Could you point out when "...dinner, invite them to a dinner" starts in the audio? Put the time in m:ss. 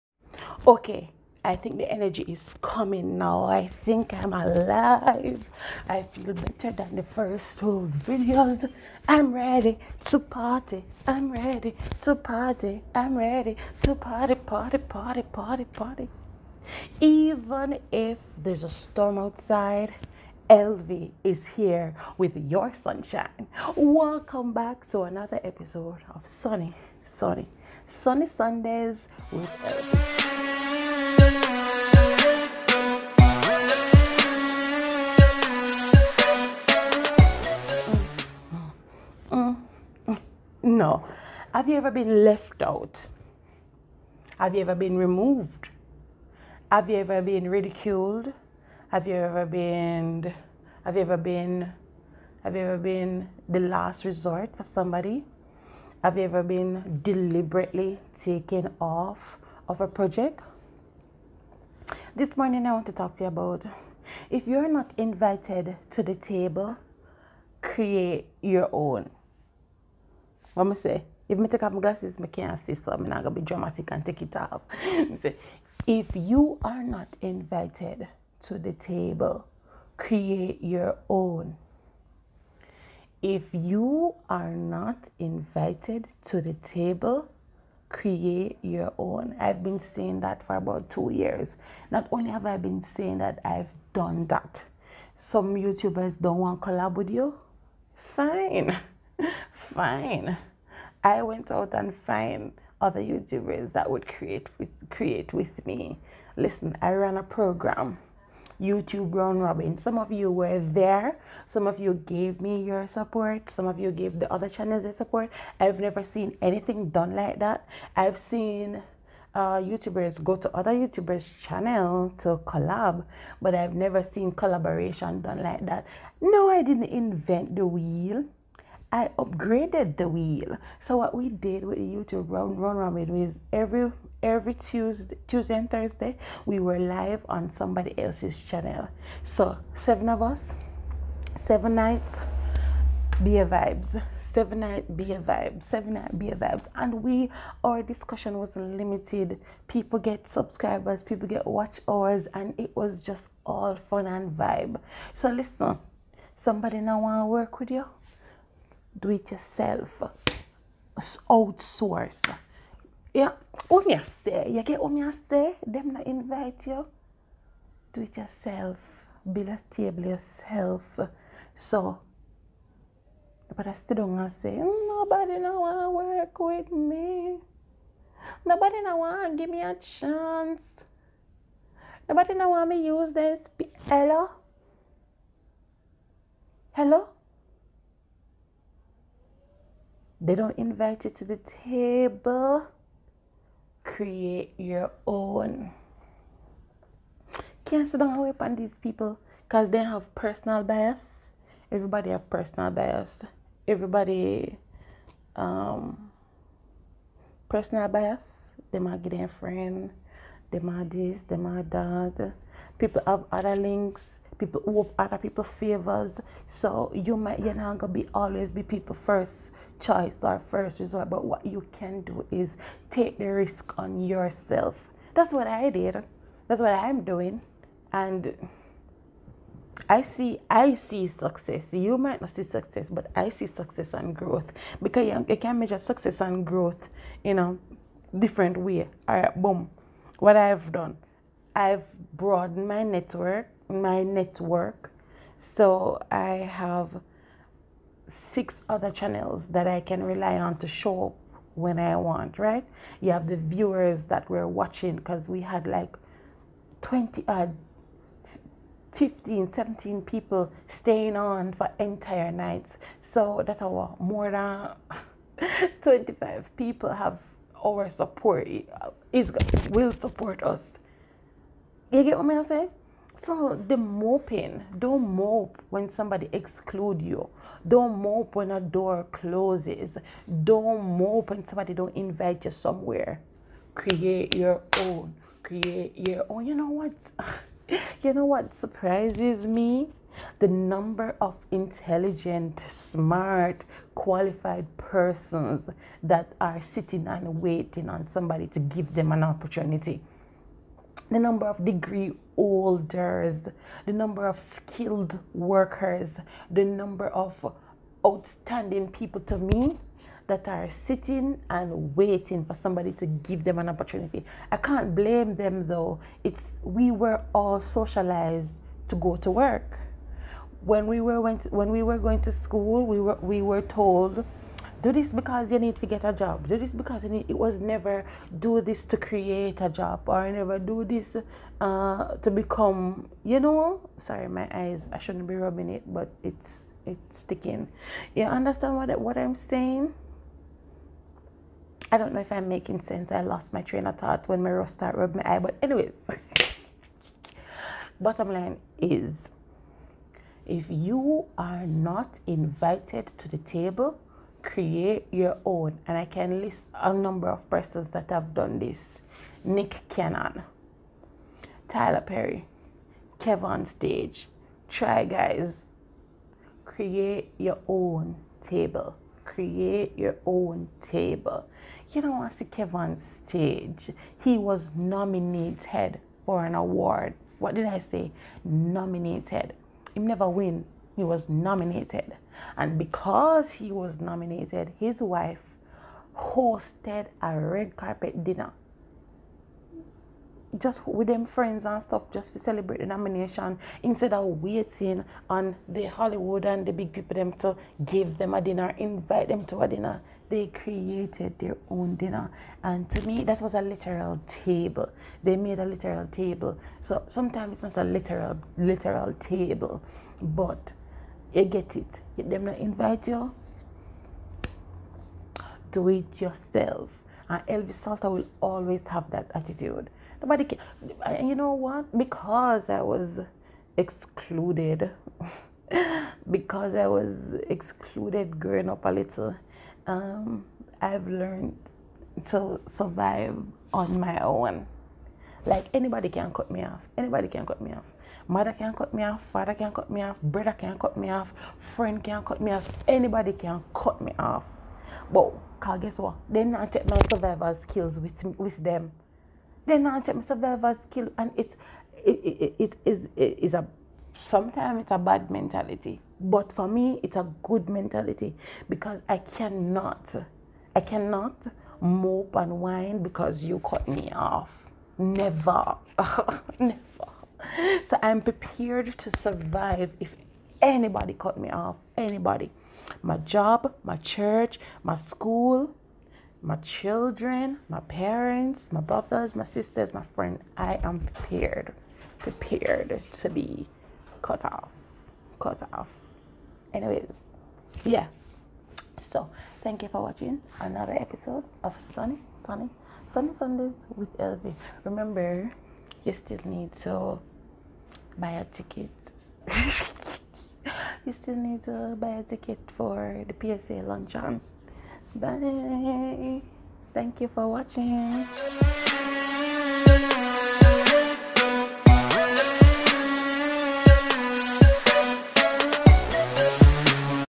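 6:38.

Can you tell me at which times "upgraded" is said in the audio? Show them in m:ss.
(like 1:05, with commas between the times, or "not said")
2:09.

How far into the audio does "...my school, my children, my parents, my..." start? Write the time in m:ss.
7:54.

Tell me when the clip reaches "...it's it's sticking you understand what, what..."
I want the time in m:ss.
5:36.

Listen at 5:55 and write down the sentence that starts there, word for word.
And I can list a number of persons that have done this Nick Cannon, Tyler Perry, Kevin Stage.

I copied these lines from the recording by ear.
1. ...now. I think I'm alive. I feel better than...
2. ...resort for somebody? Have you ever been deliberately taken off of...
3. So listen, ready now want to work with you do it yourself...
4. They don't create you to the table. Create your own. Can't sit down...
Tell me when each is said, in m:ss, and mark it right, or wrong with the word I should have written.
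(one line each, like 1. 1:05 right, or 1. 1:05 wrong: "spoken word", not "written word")
1. 0:03 right
2. 0:54 right
3. 2:35 wrong: "somebody", not "ready"
4. 3:10 wrong: "invite", not "create".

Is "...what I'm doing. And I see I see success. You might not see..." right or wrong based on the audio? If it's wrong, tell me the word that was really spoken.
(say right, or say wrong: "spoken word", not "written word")
right.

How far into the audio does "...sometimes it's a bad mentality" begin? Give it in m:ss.
7:34.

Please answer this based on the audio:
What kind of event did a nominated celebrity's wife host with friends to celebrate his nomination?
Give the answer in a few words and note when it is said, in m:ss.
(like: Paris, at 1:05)
red carpet dinner, at 6:27.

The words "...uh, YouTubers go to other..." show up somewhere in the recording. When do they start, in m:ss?
1:59.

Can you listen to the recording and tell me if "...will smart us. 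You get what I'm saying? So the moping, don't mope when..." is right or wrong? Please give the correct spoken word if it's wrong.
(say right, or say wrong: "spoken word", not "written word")
wrong: "support", not "smart".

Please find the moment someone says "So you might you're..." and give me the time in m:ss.
3:36.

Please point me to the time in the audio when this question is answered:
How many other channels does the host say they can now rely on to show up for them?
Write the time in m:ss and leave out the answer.
4:08.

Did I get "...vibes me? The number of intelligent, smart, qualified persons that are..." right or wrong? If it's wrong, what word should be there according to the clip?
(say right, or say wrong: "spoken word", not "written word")
wrong: "surprises", not "vibes".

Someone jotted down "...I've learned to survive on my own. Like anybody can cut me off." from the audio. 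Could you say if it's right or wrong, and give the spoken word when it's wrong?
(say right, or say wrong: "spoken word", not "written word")
right.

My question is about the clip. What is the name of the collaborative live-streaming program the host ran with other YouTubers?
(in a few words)
YouTube round robin.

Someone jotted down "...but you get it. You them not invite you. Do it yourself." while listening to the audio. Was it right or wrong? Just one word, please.
right.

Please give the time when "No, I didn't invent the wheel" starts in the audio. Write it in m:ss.
2:06.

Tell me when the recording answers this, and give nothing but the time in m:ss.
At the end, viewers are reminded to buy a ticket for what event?
8:23.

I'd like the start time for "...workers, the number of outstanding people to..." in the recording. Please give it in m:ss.
5:05.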